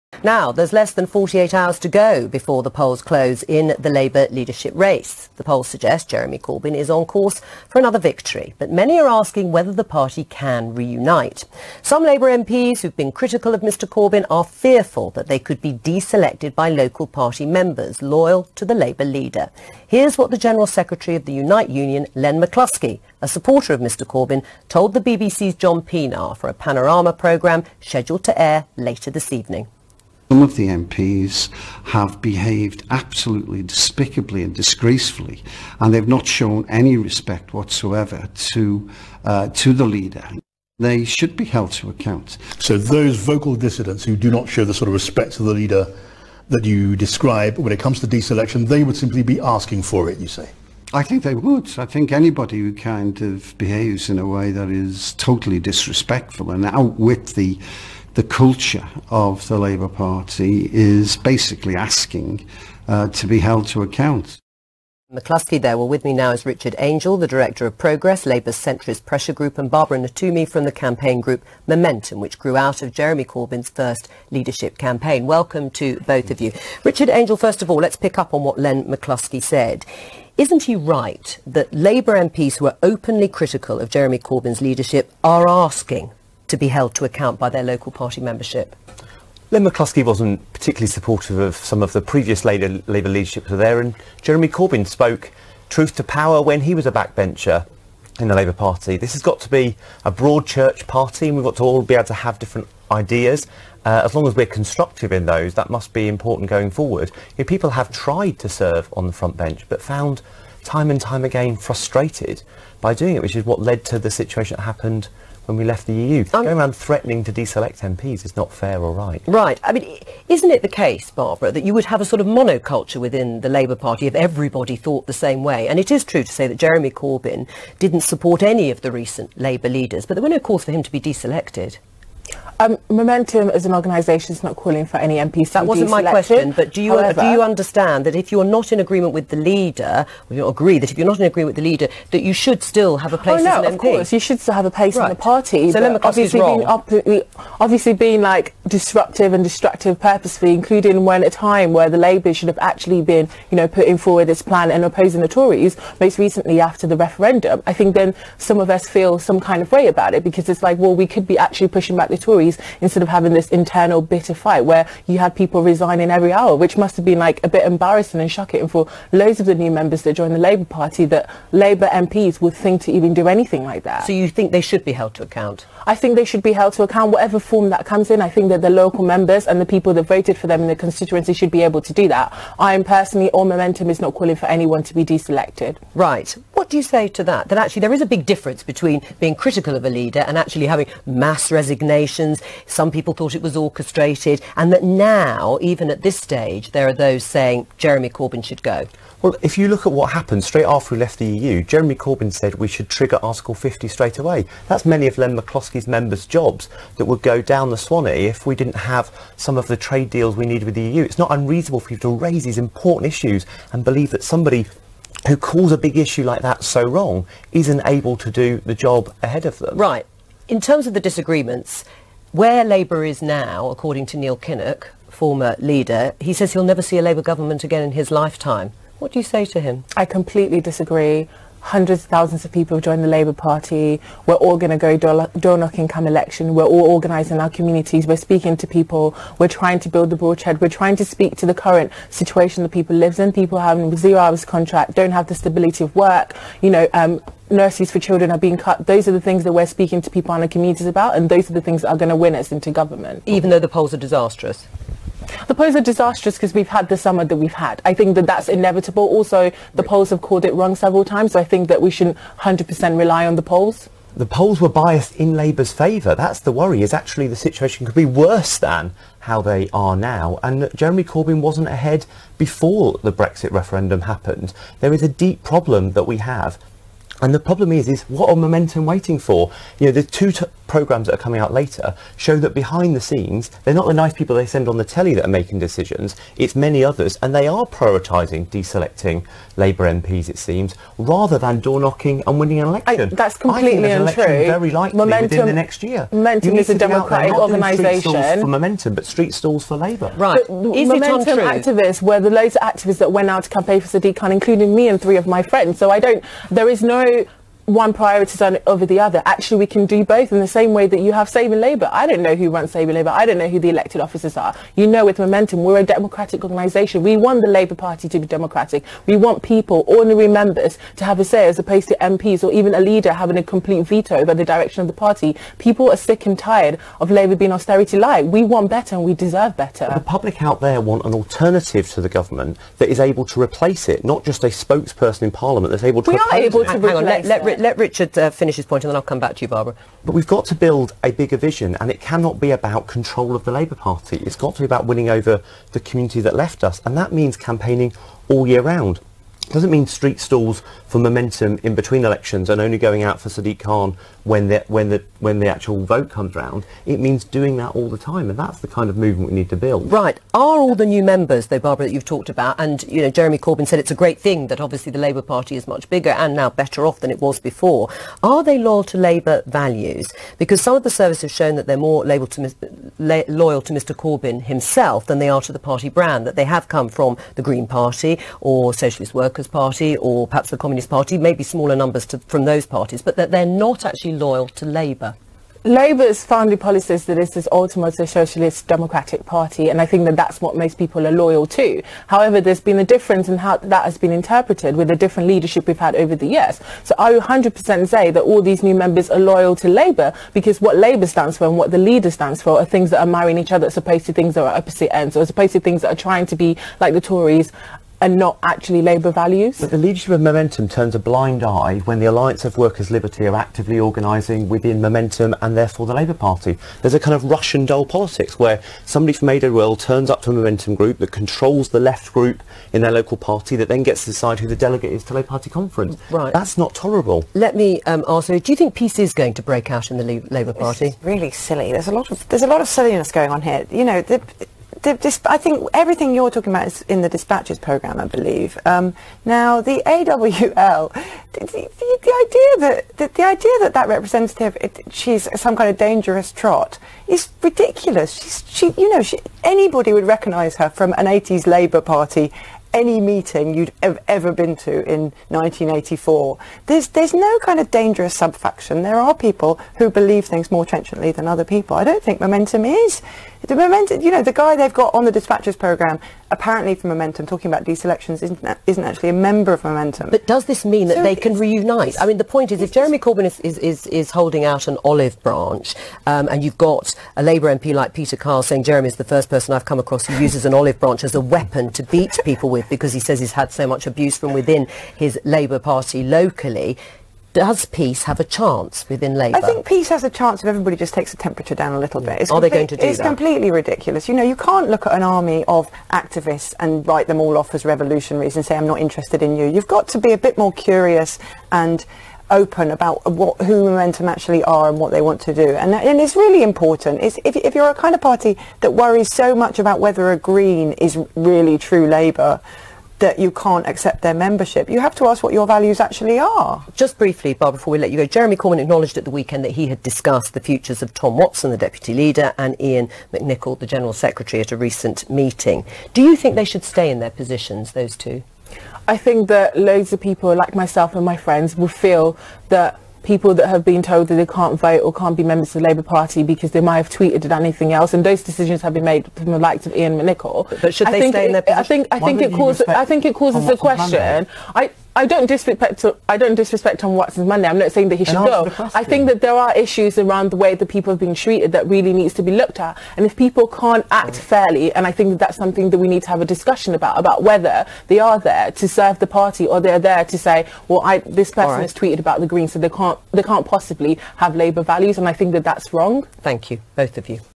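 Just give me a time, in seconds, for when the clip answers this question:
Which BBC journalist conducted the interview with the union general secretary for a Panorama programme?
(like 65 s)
25 s.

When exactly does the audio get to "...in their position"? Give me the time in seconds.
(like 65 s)
541 s.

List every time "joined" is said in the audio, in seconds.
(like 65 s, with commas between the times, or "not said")
170 s, 232 s.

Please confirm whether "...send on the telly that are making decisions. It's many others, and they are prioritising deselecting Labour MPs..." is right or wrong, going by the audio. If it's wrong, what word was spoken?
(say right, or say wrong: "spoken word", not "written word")
right.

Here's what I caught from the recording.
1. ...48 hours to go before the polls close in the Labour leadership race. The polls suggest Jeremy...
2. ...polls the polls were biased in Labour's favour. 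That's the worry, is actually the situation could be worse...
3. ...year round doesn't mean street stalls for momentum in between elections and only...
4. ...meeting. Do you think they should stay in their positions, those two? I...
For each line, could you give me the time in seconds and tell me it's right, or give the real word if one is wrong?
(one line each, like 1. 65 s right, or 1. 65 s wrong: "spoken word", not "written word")
1. 1 s right
2. 263 s right
3. 348 s right
4. 525 s right.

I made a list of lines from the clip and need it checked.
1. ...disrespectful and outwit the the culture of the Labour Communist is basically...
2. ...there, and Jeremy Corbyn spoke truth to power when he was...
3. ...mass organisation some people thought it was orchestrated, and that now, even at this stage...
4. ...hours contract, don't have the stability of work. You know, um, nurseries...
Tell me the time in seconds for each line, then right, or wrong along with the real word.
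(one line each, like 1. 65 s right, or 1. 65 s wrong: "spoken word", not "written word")
1. 55 s wrong: "Party", not "Communist"
2. 93 s right
3. 191 s wrong: "resignation", not "organisation"
4. 244 s right.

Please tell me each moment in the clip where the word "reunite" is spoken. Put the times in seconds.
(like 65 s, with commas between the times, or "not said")
10 s, 471 s.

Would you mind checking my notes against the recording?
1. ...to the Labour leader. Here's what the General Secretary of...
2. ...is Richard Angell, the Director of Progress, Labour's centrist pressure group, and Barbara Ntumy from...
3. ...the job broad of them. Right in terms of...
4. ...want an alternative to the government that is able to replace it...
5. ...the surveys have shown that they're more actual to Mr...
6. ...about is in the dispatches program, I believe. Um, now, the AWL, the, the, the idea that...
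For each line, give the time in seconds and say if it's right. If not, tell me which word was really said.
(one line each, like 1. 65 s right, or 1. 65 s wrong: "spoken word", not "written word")
1. 18 s right
2. 66 s right
3. 218 s wrong: "ahead", not "broad"
4. 330 s right
5. 370 s wrong: "loyal", not "actual"
6. 436 s right.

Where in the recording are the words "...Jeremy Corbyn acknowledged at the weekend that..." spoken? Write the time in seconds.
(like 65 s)
518 s.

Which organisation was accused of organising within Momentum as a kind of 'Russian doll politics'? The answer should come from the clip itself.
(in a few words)
Alliance of Workers' Liberty.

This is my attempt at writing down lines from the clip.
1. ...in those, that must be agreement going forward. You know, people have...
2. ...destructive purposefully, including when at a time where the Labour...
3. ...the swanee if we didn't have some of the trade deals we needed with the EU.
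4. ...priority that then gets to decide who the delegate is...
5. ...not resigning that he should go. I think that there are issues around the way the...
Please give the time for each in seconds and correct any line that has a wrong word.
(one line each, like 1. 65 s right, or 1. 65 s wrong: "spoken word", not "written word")
1. 105 s wrong: "important", not "agreement"
2. 149 s right
3. 207 s right
4. 423 s wrong: "party", not "priority"
5. 547 s wrong: "saying", not "resigning".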